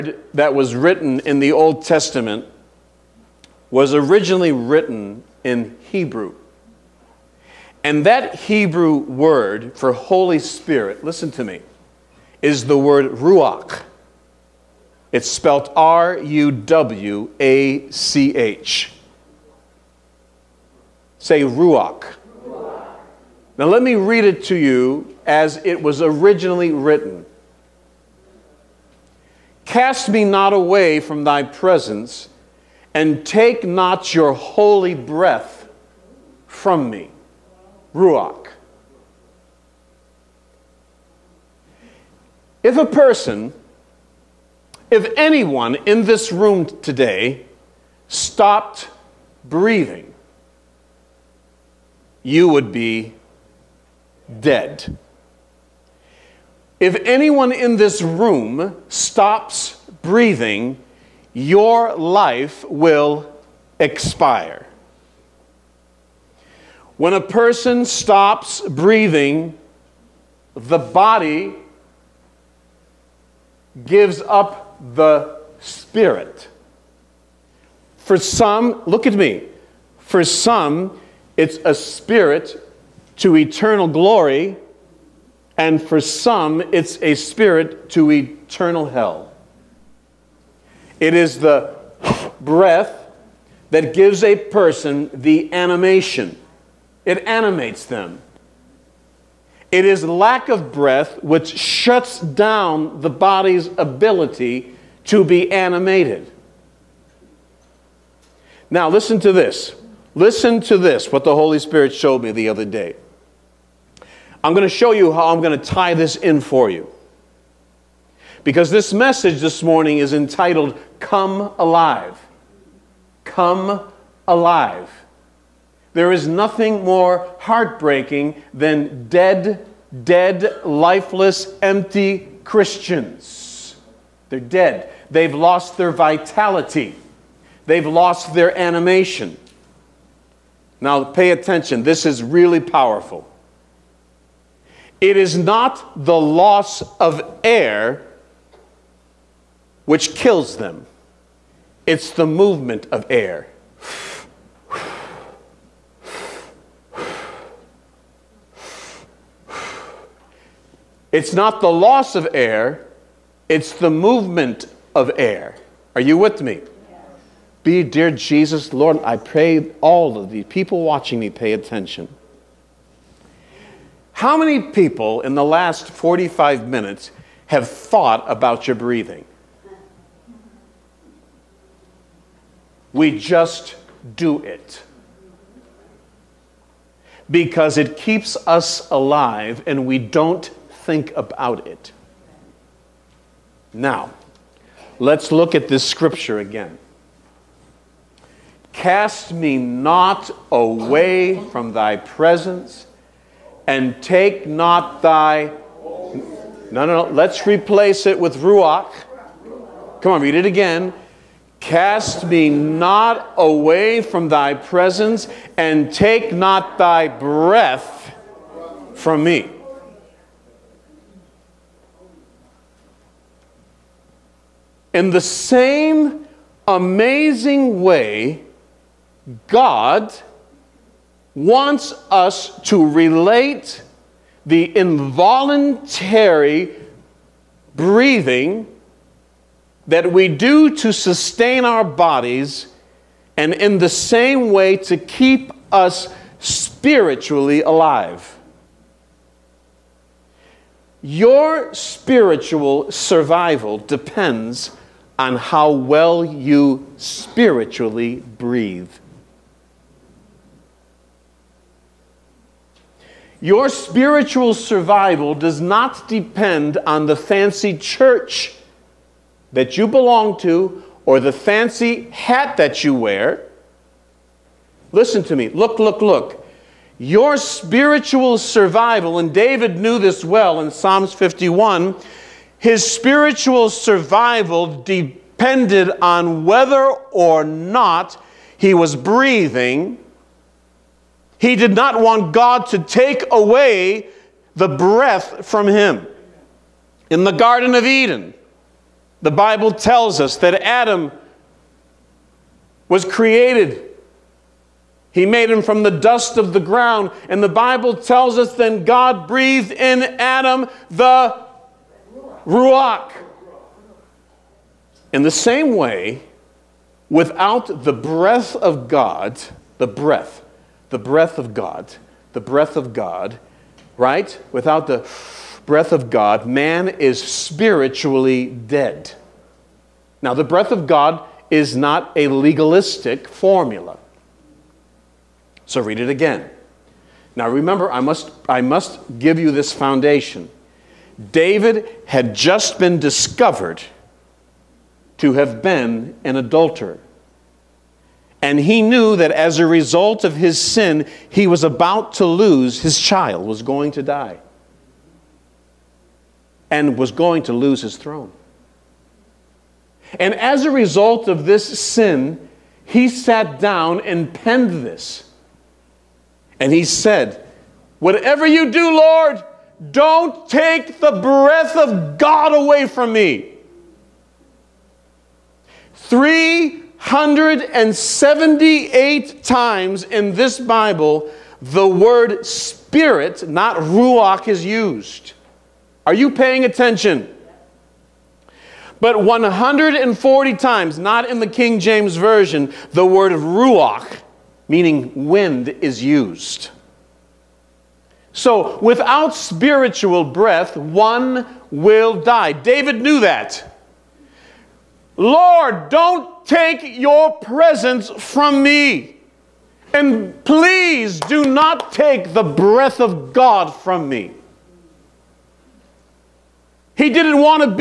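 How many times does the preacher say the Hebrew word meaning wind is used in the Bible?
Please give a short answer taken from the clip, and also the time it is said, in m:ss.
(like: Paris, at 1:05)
140, at 6:29.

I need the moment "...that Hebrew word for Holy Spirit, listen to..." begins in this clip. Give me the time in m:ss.
0:08.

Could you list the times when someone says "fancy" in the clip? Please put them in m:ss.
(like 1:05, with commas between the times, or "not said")
4:27, 4:31.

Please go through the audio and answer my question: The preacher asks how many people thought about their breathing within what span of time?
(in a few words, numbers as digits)
45 minutes.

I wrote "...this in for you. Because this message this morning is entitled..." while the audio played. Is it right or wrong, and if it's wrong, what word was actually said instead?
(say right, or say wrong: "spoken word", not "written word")
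right.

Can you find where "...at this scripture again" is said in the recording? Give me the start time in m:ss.
3:15.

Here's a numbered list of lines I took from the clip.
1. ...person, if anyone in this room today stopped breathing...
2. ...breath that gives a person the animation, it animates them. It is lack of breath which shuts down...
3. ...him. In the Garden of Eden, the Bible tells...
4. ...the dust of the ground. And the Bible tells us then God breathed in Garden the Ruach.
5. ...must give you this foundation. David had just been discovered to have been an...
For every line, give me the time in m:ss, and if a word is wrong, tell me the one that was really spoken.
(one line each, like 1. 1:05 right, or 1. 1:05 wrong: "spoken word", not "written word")
1. 0:42 right
2. 1:32 right
3. 4:55 right
4. 5:05 wrong: "Adam", not "Garden"
5. 5:38 right.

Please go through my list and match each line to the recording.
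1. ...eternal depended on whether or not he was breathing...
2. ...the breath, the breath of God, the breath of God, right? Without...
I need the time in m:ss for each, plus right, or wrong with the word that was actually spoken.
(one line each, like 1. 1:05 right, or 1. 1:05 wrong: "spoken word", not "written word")
1. 4:43 wrong: "survival", not "eternal"
2. 5:19 right.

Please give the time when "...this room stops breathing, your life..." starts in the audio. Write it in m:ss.
0:57.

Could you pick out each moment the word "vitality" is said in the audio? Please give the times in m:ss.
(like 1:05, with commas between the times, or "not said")
2:15.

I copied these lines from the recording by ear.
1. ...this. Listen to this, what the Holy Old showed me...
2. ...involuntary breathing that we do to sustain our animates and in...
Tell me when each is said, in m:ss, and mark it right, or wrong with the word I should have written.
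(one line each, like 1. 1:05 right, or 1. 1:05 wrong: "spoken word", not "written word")
1. 1:49 wrong: "Spirit", not "Old"
2. 3:54 wrong: "bodies", not "animates".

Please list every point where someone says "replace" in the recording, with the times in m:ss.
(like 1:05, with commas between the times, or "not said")
3:27.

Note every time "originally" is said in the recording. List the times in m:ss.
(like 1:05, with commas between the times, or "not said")
0:03, 0:26.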